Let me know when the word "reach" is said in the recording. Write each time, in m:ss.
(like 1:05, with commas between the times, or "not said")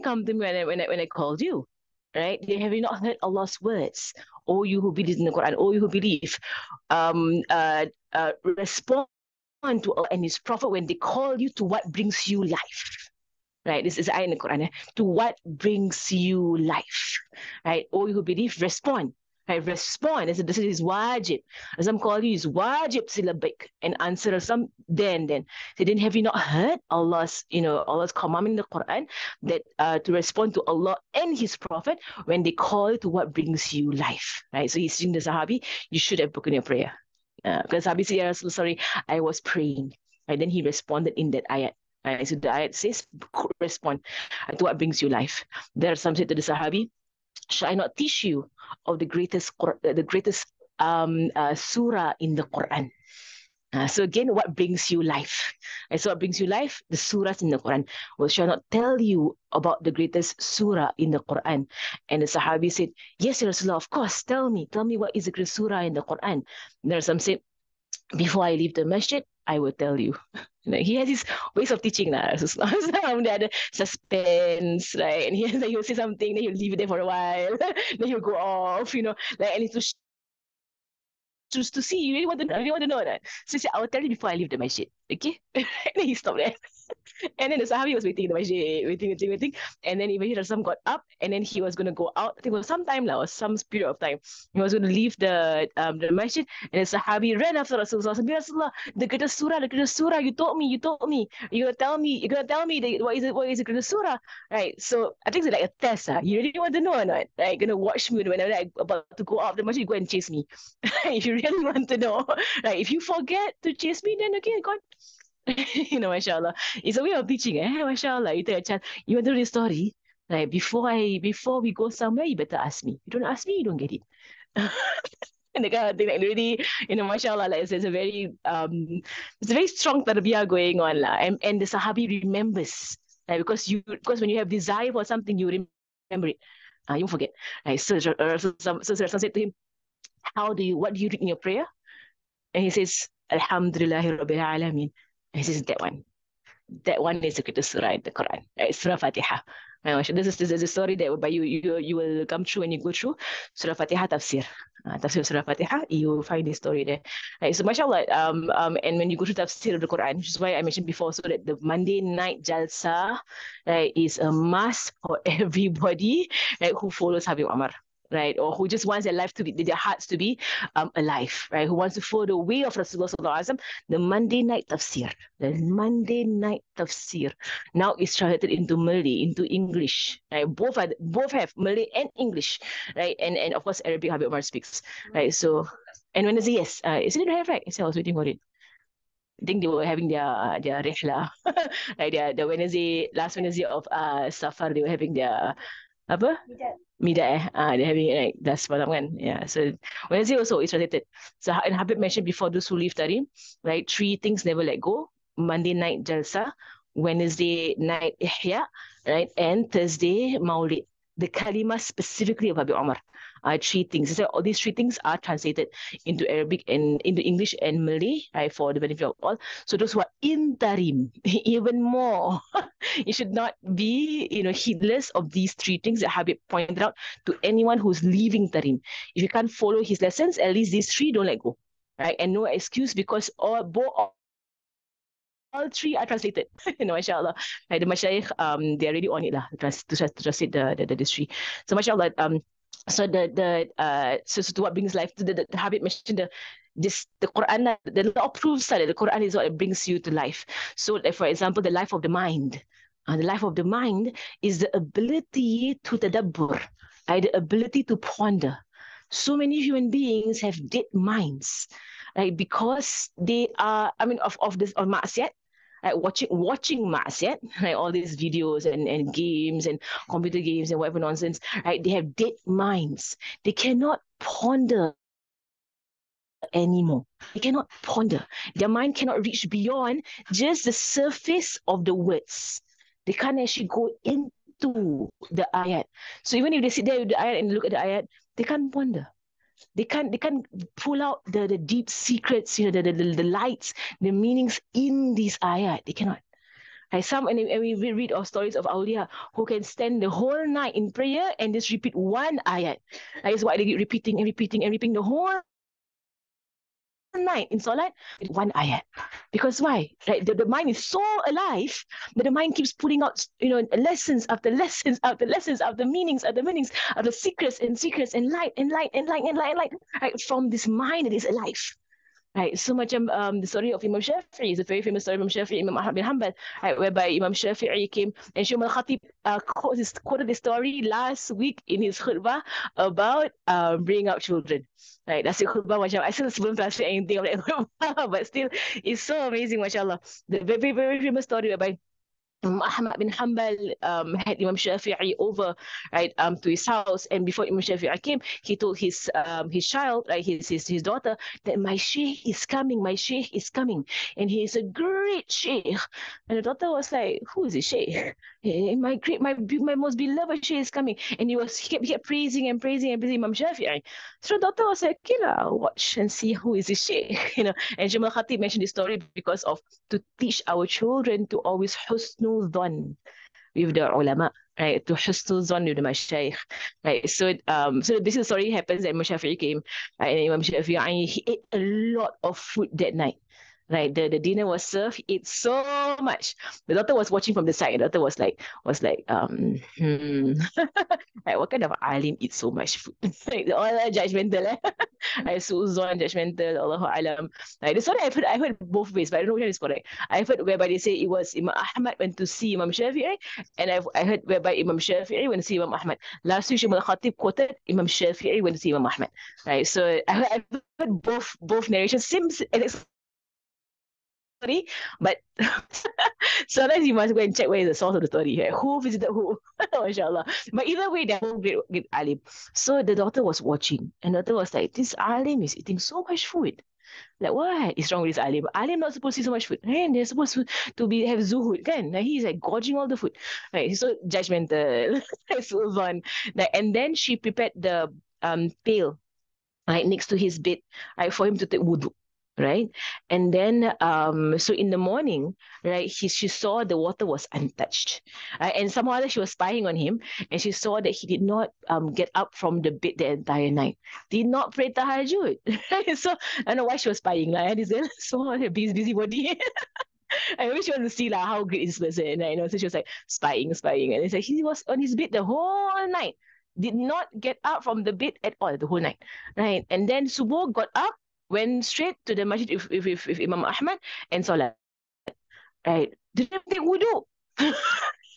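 4:39.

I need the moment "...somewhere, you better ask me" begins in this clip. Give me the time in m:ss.
2:01.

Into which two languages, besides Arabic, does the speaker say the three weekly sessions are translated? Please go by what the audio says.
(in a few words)
Malay and English.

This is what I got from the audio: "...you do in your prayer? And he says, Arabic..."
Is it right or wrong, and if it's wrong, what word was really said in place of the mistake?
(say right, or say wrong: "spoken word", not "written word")
wrong: "Alhamdulillah", not "Arabic".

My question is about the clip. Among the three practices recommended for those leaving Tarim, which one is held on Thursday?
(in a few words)
Maulid.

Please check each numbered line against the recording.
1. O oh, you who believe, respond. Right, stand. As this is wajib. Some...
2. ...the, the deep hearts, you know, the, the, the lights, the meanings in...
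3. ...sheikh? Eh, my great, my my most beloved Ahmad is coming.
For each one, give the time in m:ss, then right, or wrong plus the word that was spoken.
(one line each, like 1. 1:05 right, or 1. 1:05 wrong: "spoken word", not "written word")
1. 0:17 wrong: "respond", not "stand"
2. 4:51 wrong: "secrets", not "hearts"
3. 5:57 wrong: "Shay", not "Ahmad".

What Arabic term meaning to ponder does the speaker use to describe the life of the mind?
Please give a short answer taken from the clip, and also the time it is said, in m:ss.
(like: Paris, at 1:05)
tadabbur, at 4:15.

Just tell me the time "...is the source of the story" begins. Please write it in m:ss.
6:57.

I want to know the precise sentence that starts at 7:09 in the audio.
And eh, they're supposed to, to be have zuhud.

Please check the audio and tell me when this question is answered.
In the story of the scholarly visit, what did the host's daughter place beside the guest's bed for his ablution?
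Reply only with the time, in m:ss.
7:18.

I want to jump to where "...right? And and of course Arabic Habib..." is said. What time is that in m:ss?
3:02.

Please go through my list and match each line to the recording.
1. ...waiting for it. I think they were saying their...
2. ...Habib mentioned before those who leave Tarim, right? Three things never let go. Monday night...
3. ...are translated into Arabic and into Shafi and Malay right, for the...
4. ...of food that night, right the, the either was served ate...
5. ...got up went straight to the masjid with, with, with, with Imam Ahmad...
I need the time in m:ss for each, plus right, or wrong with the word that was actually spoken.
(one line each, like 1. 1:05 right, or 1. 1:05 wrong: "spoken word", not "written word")
1. 3:07 wrong: "having", not "saying"
2. 3:21 right
3. 3:35 wrong: "English", not "Shafi"
4. 6:22 wrong: "dinner", not "either"
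5. 7:50 right.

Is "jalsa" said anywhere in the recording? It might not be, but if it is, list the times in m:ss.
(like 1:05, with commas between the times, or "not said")
2:42, 3:26.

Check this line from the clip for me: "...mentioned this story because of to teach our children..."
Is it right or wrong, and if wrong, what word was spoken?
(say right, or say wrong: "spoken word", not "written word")
right.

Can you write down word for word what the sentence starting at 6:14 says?
To husnul zon with the mashayikh, right?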